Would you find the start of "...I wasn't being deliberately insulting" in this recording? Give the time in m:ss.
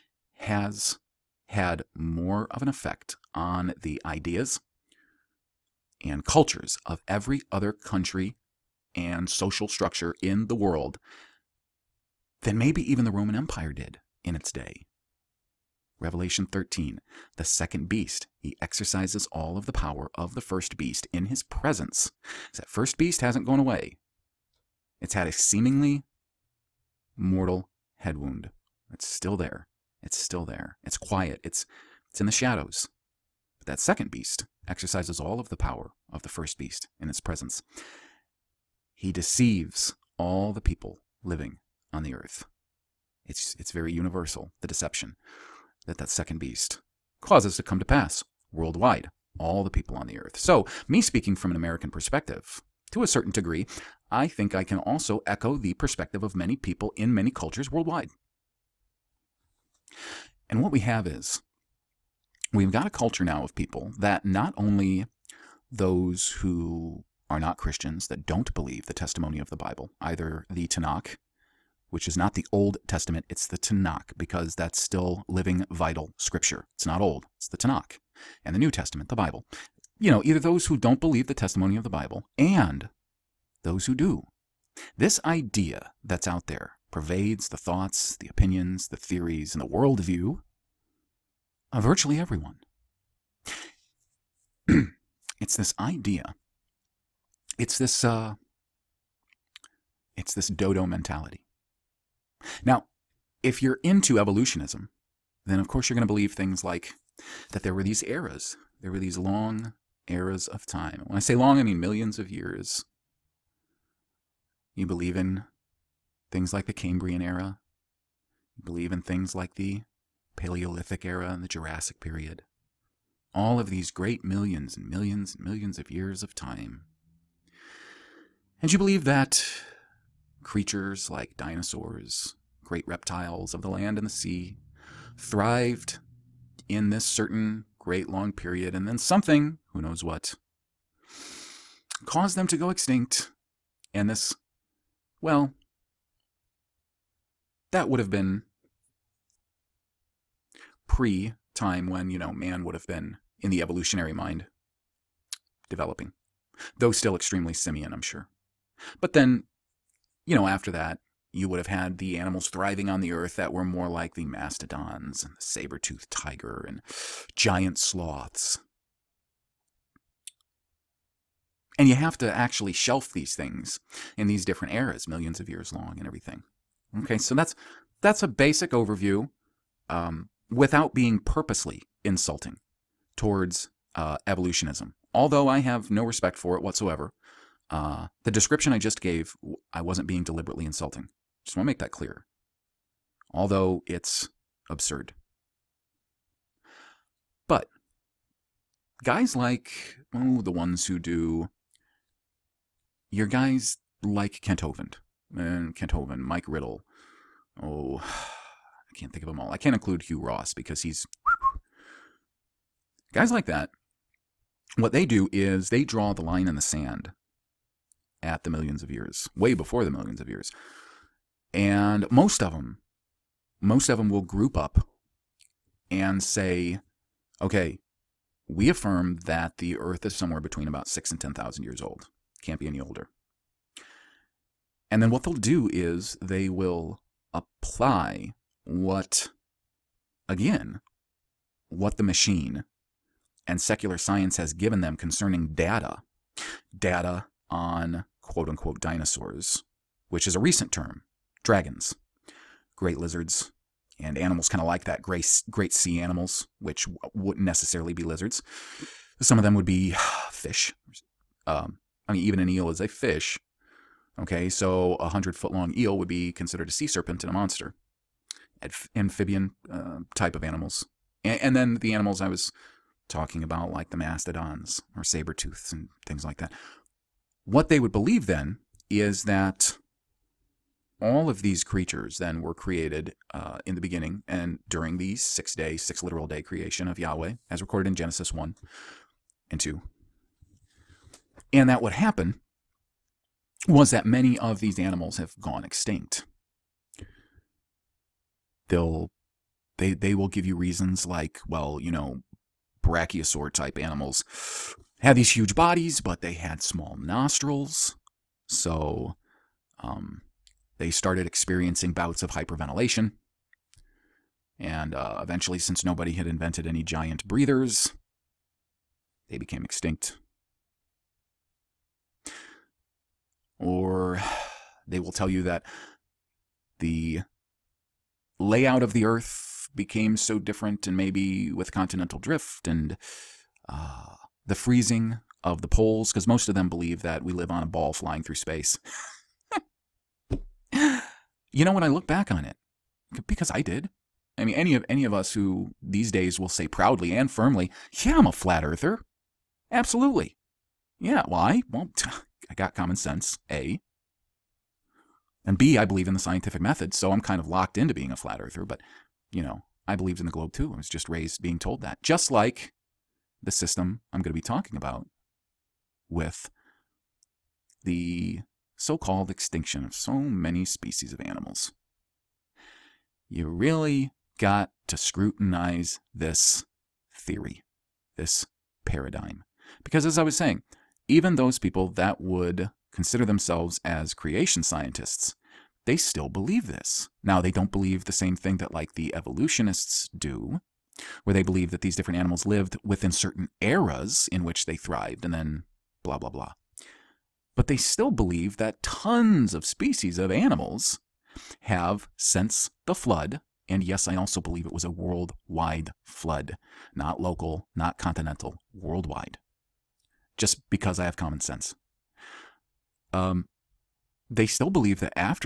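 3:09.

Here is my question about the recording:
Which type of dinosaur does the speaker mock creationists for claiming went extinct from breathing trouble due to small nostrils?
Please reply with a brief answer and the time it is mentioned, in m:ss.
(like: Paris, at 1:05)
Brachiosaur, at 5:02.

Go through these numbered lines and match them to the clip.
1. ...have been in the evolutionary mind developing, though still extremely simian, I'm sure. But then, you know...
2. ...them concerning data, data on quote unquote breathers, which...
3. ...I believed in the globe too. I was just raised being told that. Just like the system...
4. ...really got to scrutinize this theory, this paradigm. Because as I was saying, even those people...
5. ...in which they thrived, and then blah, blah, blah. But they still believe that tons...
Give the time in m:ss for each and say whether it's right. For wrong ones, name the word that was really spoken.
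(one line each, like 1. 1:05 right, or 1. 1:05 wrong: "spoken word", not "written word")
1. 2:32 right
2. 4:04 wrong: "dinosaurs", not "breathers"
3. 5:59 right
4. 6:13 right
5. 6:34 right.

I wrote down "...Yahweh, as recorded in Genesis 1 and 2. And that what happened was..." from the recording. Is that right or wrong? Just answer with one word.
right.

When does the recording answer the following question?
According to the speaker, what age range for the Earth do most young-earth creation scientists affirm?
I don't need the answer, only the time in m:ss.
3:50.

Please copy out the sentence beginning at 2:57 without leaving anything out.
Okay, so that's that's a basic overview um, without being purposely insulting towards uh, evolutionism.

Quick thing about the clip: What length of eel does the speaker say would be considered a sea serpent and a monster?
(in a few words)
100 feet.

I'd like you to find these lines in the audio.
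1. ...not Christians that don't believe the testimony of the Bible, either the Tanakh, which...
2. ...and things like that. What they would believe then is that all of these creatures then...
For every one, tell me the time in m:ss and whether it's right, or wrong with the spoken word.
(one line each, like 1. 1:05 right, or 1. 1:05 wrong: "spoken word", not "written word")
1. 1:07 right
2. 4:35 right.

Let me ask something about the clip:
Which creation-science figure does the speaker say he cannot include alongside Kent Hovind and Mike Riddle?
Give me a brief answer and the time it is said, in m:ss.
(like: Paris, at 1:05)
Hugh Ross, at 3:30.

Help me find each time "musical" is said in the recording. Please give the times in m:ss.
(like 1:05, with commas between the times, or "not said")
not said.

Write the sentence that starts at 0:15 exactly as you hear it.
Revelation 13, the second beast he exercises all of the power of the first beast in his presence.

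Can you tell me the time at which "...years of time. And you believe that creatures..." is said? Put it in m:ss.
2:05.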